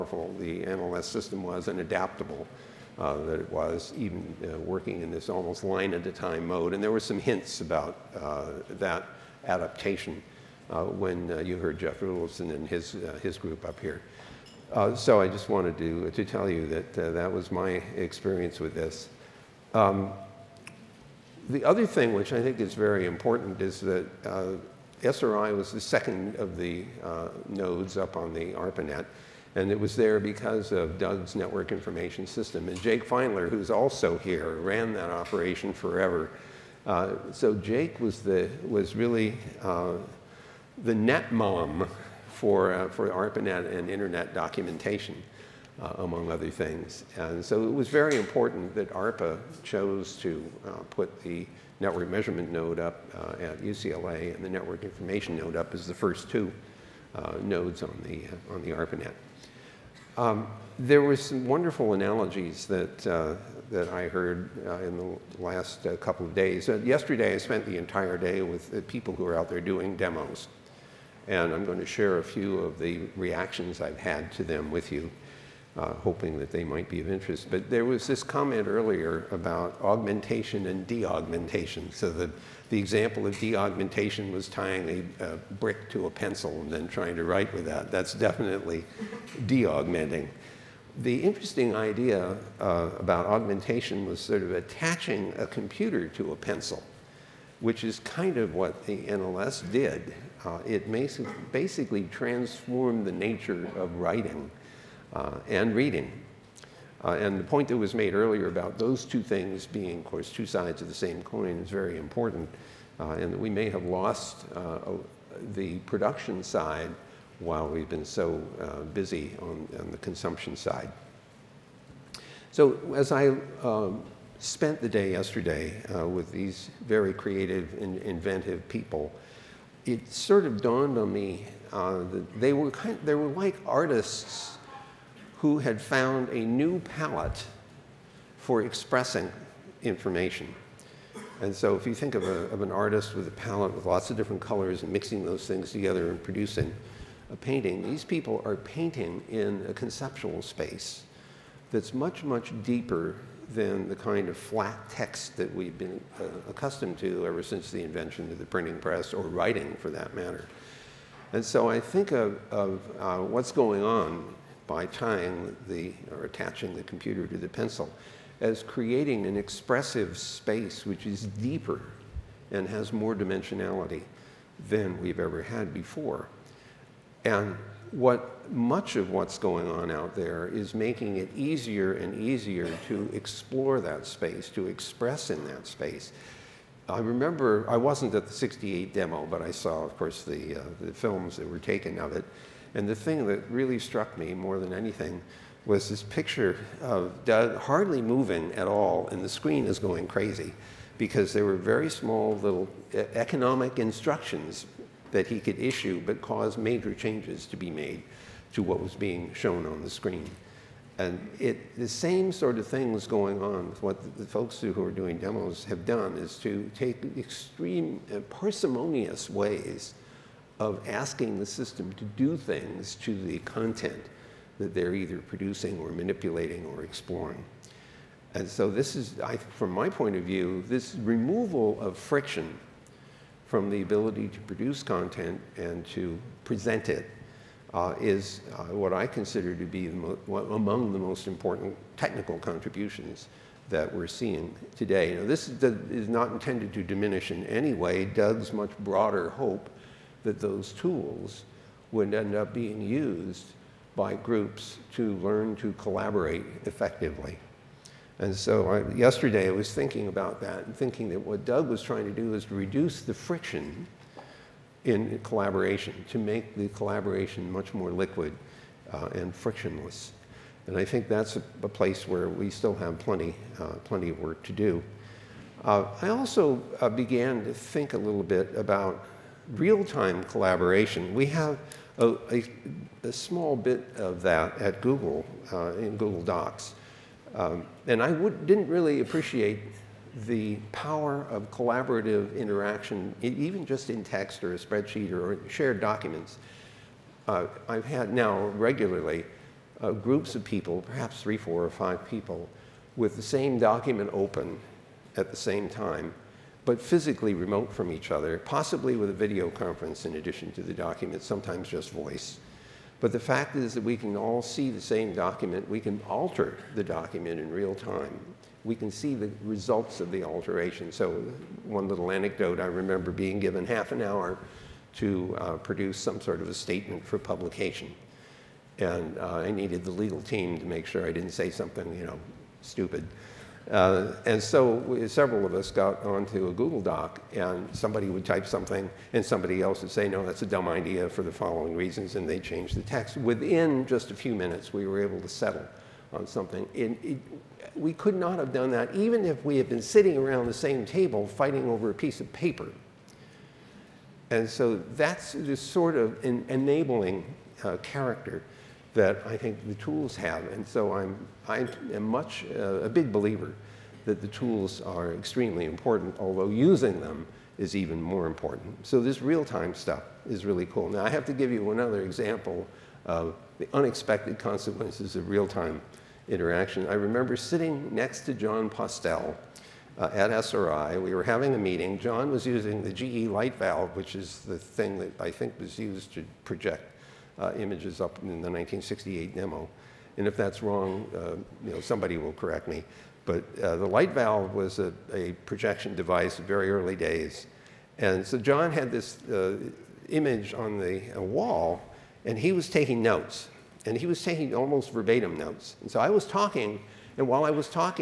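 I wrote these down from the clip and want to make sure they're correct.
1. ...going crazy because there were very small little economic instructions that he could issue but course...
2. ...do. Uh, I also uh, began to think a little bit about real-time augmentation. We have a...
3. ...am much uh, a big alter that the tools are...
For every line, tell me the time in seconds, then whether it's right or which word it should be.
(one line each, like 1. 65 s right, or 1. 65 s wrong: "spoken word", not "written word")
1. 199 s wrong: "cause", not "course"
2. 274 s wrong: "collaboration", not "augmentation"
3. 361 s wrong: "believer", not "alter".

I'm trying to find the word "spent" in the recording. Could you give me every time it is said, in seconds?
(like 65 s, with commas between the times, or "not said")
67 s, 124 s.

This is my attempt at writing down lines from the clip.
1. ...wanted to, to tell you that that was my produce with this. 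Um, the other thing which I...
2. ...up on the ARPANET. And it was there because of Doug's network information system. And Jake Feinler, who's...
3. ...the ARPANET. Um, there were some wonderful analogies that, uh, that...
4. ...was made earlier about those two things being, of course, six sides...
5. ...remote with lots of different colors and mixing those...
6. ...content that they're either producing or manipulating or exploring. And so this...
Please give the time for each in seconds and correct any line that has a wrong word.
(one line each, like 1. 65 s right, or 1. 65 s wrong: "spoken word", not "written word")
1. 15 s wrong: "experience", not "produce"
2. 27 s right
3. 58 s right
4. 107 s wrong: "two", not "six"
5. 143 s wrong: "palette", not "remote"
6. 223 s right.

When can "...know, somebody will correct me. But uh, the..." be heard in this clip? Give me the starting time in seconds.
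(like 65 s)
391 s.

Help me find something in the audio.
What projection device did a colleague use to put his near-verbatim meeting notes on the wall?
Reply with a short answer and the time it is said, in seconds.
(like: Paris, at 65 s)
GE light valve, at 382 s.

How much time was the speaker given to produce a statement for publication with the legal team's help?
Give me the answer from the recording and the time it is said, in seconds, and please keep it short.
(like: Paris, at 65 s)
half an hour, at 323 s.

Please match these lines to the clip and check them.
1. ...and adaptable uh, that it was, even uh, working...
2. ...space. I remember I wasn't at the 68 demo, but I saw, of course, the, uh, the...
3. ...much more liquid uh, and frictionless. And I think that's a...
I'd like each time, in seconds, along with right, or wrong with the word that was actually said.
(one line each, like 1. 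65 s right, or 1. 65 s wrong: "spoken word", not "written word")
1. 1 s right
2. 185 s right
3. 267 s right.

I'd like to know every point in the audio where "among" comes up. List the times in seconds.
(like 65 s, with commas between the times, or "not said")
45 s, 240 s.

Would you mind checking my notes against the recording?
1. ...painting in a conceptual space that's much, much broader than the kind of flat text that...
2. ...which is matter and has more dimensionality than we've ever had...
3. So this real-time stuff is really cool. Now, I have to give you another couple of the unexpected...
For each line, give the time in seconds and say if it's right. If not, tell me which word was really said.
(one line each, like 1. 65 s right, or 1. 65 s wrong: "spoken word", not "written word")
1. 148 s wrong: "deeper", not "broader"
2. 170 s wrong: "deeper", not "matter"
3. 368 s wrong: "example", not "couple".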